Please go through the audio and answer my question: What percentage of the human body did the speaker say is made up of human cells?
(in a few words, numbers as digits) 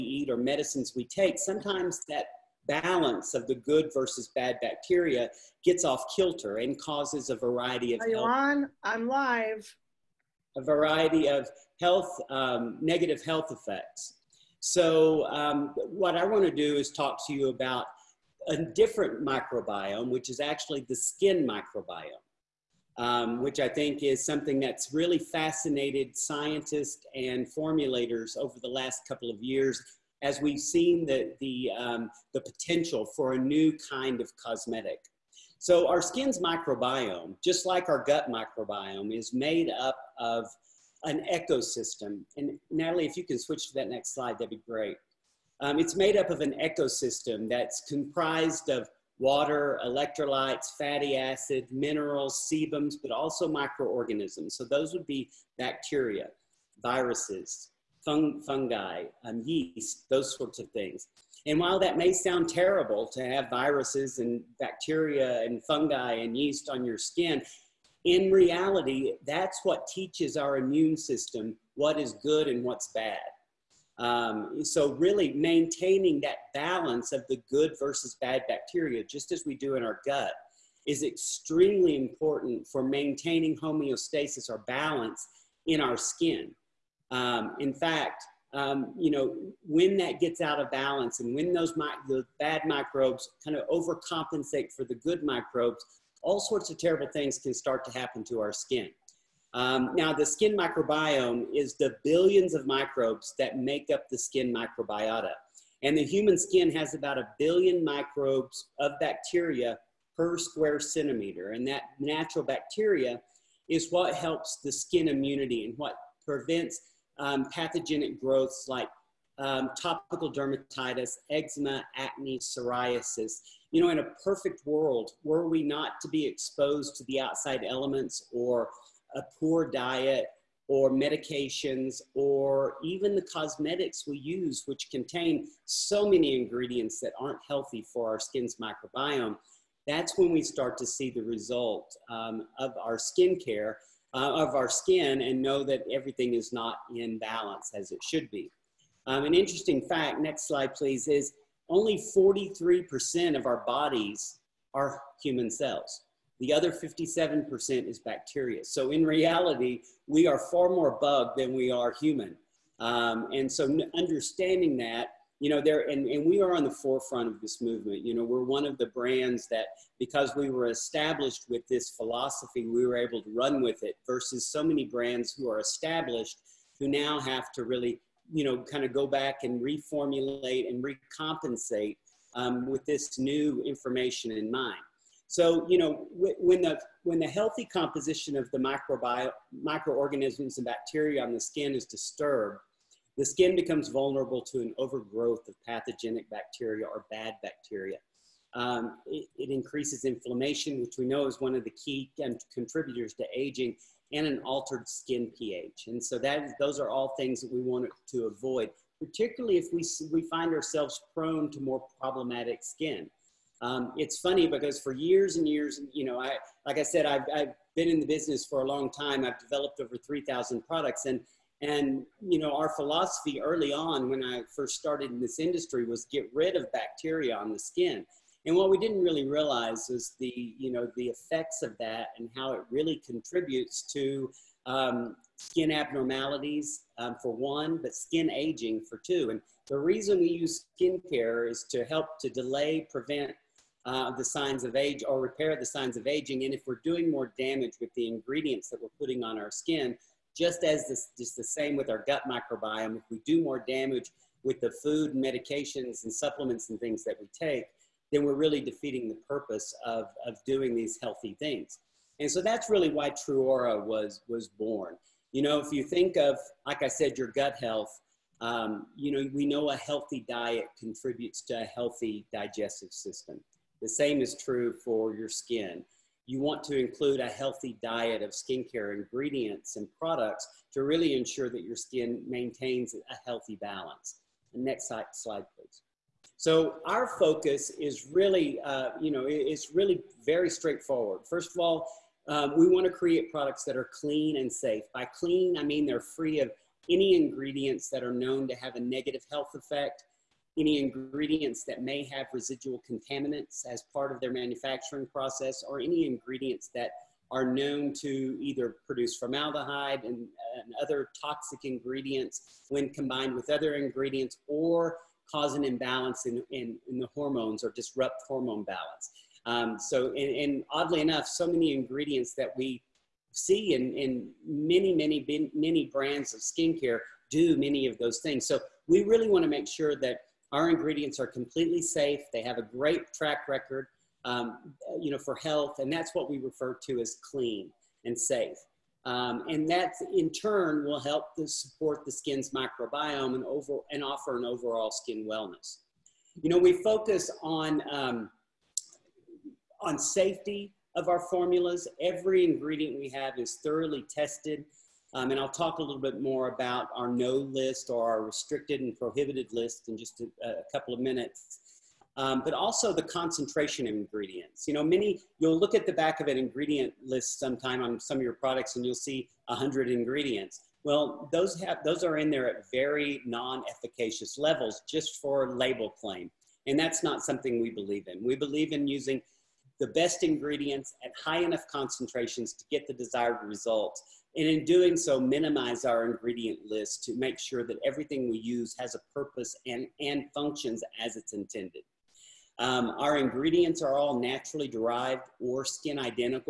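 43%.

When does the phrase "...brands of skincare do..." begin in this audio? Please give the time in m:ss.
5:25.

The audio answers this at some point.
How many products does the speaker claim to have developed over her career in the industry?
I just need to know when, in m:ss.
3:39.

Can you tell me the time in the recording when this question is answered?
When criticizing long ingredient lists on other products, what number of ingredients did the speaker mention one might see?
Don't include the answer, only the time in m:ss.
6:09.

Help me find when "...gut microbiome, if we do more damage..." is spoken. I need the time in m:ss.
4:12.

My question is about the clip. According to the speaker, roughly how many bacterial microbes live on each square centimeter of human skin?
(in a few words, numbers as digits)
a billion.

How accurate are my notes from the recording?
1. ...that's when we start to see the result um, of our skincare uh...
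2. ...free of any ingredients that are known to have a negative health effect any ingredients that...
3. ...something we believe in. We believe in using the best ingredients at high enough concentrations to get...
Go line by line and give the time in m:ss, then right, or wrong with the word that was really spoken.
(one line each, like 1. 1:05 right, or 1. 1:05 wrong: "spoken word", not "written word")
1. 2:19 right
2. 4:55 right
3. 6:17 right.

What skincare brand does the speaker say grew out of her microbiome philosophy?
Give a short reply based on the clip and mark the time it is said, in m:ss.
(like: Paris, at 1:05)
Truora, at 4:23.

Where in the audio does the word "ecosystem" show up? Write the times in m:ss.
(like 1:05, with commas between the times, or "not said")
0:41, 0:46.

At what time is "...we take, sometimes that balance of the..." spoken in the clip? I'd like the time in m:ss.
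0:00.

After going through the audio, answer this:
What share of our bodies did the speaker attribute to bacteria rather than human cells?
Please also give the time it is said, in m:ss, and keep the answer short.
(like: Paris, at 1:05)
57%, at 2:36.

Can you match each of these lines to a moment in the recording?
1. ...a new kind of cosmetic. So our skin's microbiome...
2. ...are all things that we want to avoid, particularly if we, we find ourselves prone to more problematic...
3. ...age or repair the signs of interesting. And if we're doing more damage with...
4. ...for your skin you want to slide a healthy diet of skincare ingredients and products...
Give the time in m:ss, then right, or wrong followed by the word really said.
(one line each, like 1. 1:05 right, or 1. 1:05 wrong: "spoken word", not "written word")
1. 0:33 right
2. 3:26 right
3. 4:04 wrong: "aging", not "interesting"
4. 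4:34 wrong: "include", not "slide".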